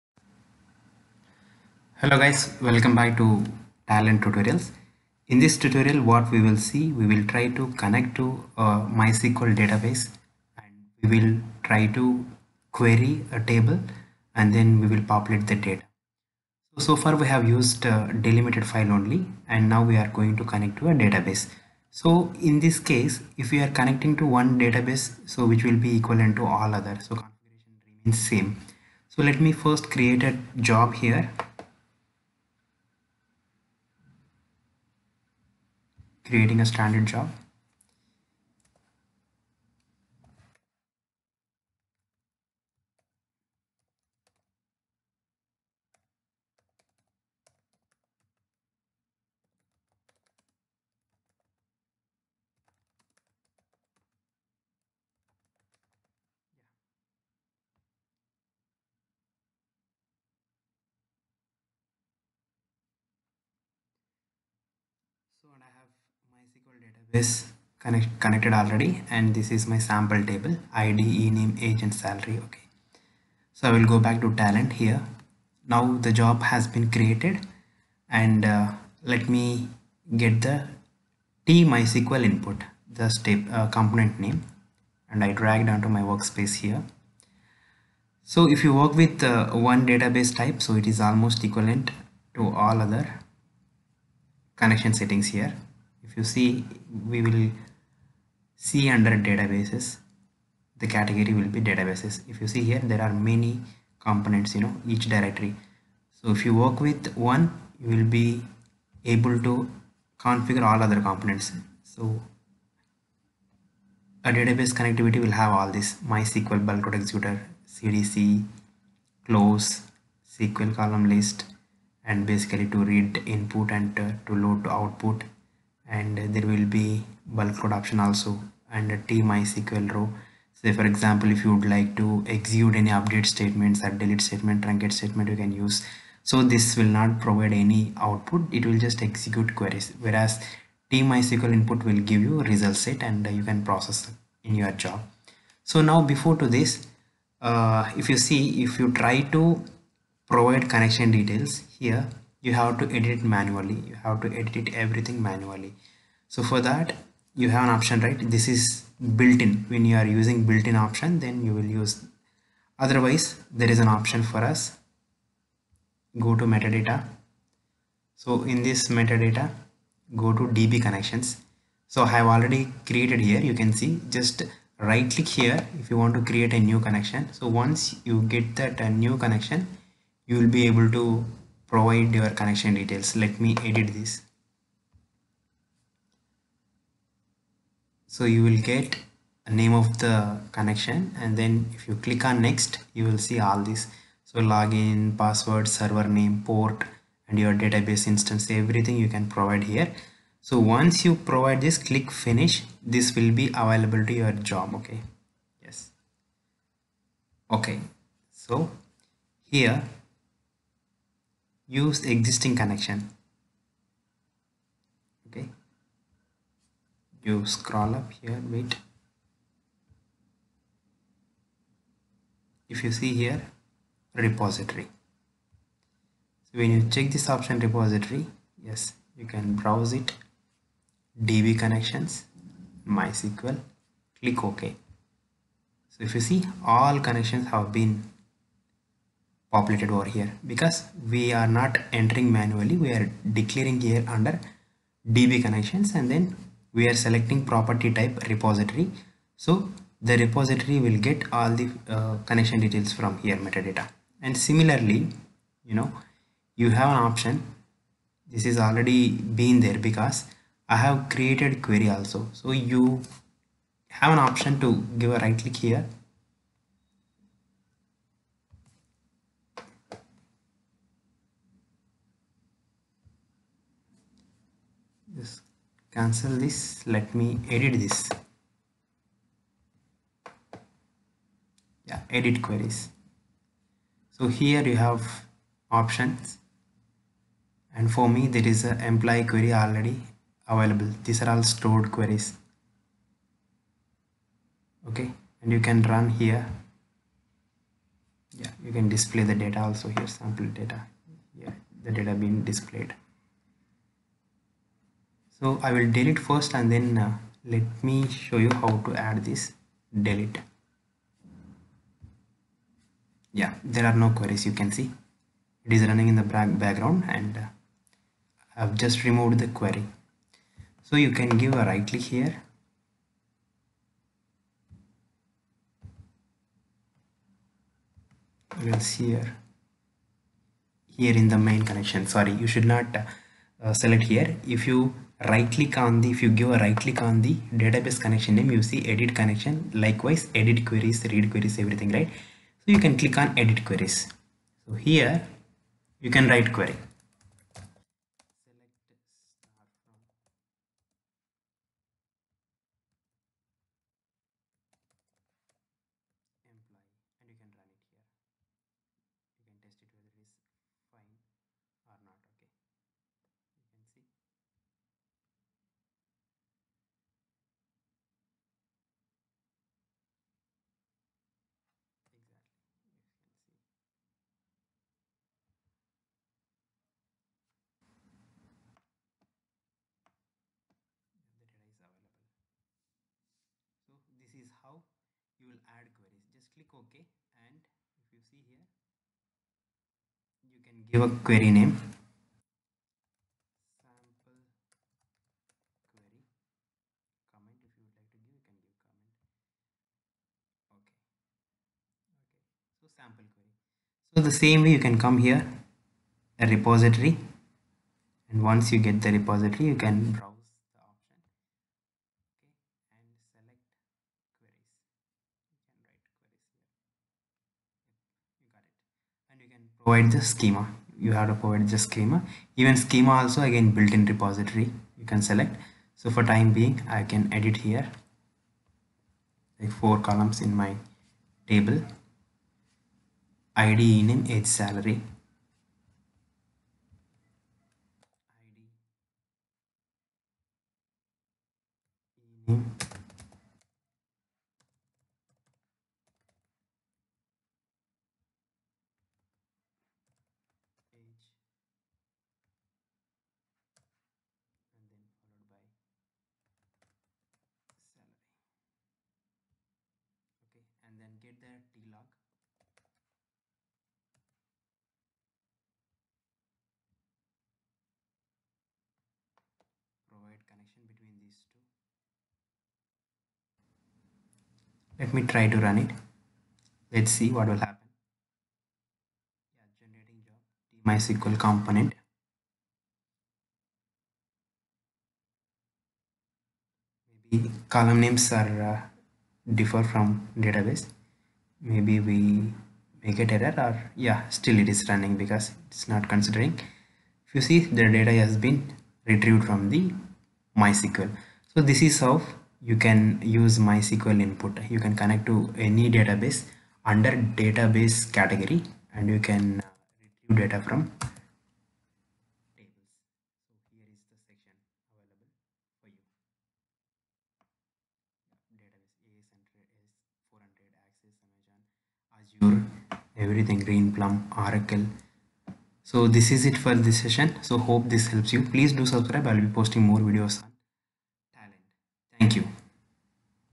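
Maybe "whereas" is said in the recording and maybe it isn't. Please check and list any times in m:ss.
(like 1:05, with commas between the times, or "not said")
2:20.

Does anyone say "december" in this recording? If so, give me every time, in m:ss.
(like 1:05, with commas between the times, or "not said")
not said.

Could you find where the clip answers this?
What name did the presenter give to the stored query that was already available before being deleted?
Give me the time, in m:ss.
4:48.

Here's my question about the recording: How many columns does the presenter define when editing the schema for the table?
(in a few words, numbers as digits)
4.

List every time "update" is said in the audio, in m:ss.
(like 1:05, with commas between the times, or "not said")
2:12.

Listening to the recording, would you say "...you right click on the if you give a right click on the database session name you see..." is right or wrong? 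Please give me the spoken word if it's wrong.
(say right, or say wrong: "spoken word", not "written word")
wrong: "connection", not "session".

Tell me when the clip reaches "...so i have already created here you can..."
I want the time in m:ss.
2:51.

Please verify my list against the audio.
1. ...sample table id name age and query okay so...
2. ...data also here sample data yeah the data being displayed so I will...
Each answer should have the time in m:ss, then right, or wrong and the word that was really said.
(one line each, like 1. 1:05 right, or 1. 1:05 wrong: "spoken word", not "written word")
1. 1:09 wrong: "salary", not "query"
2. 4:59 right.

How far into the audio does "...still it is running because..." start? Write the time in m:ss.
8:14.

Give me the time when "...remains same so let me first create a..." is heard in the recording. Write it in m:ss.
0:27.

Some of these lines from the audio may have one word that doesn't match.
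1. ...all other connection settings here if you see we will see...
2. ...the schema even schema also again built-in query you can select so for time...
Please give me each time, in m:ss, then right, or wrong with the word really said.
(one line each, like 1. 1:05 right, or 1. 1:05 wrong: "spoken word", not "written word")
1. 1:32 right
2. 7:01 wrong: "repository", not "query".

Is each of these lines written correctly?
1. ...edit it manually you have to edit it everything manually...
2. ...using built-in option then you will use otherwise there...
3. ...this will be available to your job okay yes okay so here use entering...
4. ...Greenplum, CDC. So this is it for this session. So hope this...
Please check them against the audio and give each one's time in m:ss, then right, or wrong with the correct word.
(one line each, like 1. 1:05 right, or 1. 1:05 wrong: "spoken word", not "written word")
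1. 2:32 right
2. 2:40 right
3. 3:22 wrong: "existing", not "entering"
4. 8:43 wrong: "Oracle", not "CDC".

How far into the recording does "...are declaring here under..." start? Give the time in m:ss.
4:02.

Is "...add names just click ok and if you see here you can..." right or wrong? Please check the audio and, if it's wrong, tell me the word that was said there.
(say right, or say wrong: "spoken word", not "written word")
wrong: "queries", not "names".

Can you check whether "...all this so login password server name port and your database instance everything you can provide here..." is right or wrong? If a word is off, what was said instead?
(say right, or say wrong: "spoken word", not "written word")
right.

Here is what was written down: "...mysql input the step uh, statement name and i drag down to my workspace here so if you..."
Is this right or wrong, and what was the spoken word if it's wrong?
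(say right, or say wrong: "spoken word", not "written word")
wrong: "component", not "statement".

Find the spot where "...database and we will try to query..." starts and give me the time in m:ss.
0:09.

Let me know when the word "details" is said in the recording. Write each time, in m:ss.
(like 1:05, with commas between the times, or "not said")
2:31, 3:02, 4:12.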